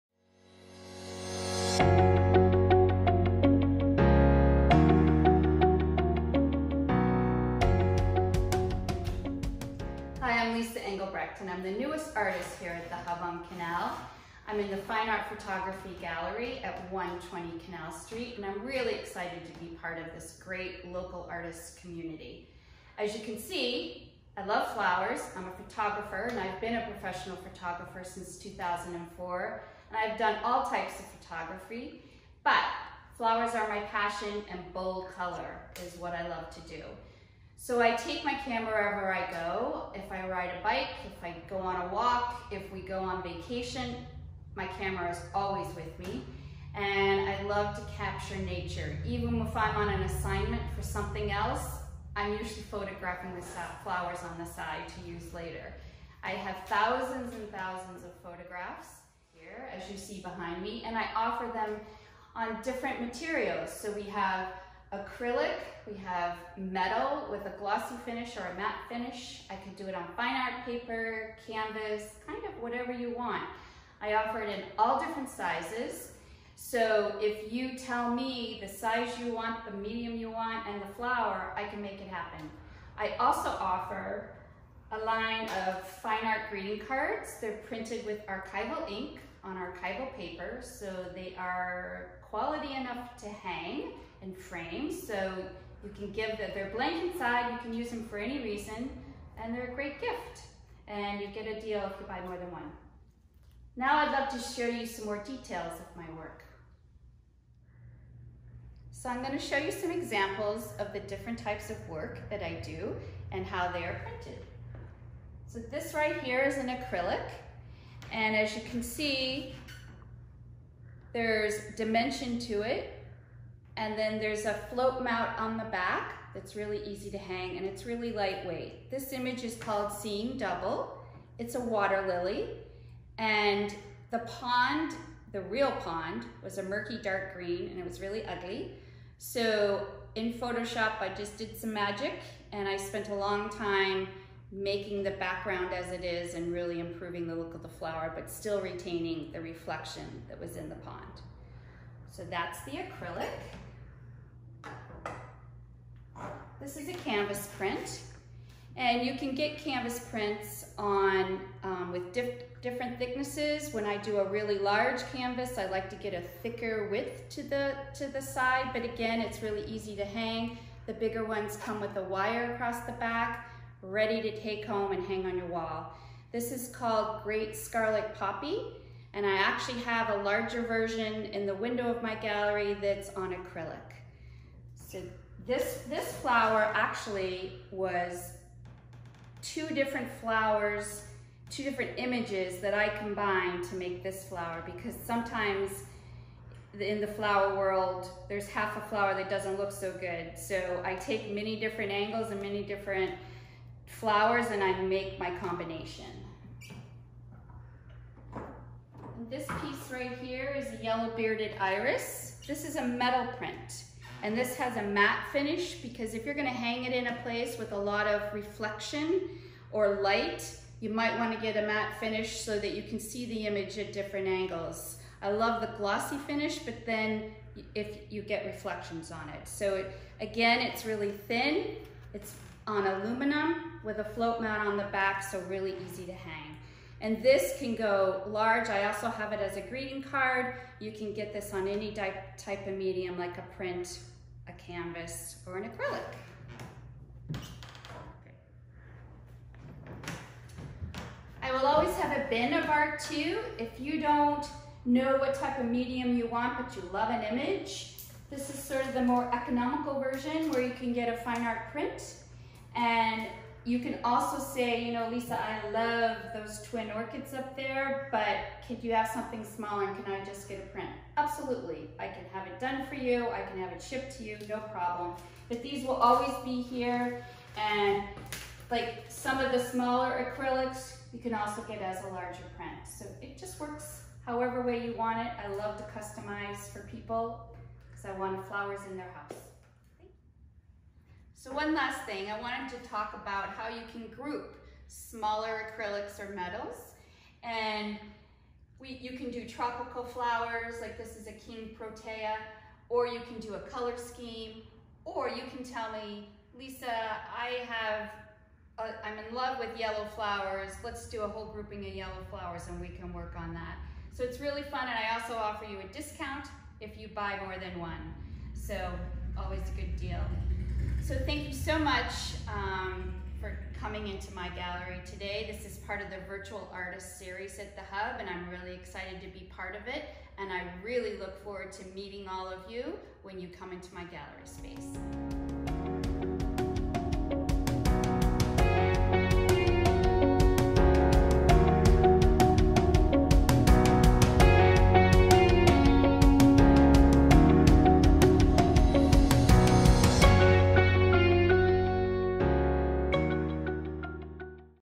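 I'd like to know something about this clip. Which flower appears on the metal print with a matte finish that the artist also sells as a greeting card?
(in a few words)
Yellow bearded iris.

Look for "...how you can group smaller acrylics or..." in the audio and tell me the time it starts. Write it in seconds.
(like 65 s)
293 s.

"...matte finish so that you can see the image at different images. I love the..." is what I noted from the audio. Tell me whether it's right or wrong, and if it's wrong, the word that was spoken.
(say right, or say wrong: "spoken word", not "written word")
wrong: "angles", not "images".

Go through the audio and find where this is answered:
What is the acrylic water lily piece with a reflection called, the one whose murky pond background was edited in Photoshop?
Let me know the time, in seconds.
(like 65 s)
129 s.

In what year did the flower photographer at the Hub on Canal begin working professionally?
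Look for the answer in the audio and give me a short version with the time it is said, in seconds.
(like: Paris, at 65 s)
2004, at 28 s.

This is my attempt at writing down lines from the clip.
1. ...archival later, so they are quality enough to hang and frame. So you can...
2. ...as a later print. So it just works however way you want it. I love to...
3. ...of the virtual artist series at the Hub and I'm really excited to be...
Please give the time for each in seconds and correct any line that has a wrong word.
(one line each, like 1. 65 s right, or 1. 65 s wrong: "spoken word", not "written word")
1. 89 s wrong: "paper", not "later"
2. 281 s wrong: "larger", not "later"
3. 326 s right.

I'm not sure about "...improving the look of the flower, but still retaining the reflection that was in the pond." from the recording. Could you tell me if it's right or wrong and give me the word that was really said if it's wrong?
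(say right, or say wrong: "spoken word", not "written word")
right.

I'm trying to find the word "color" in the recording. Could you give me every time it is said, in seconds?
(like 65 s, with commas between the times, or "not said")
35 s, 303 s.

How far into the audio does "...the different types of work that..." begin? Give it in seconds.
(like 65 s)
110 s.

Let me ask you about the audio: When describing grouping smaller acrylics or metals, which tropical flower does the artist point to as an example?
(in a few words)
King Protea.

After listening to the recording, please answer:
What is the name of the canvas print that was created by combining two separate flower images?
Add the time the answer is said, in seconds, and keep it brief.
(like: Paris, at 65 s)
Great Scarlet Poppy, at 177 s.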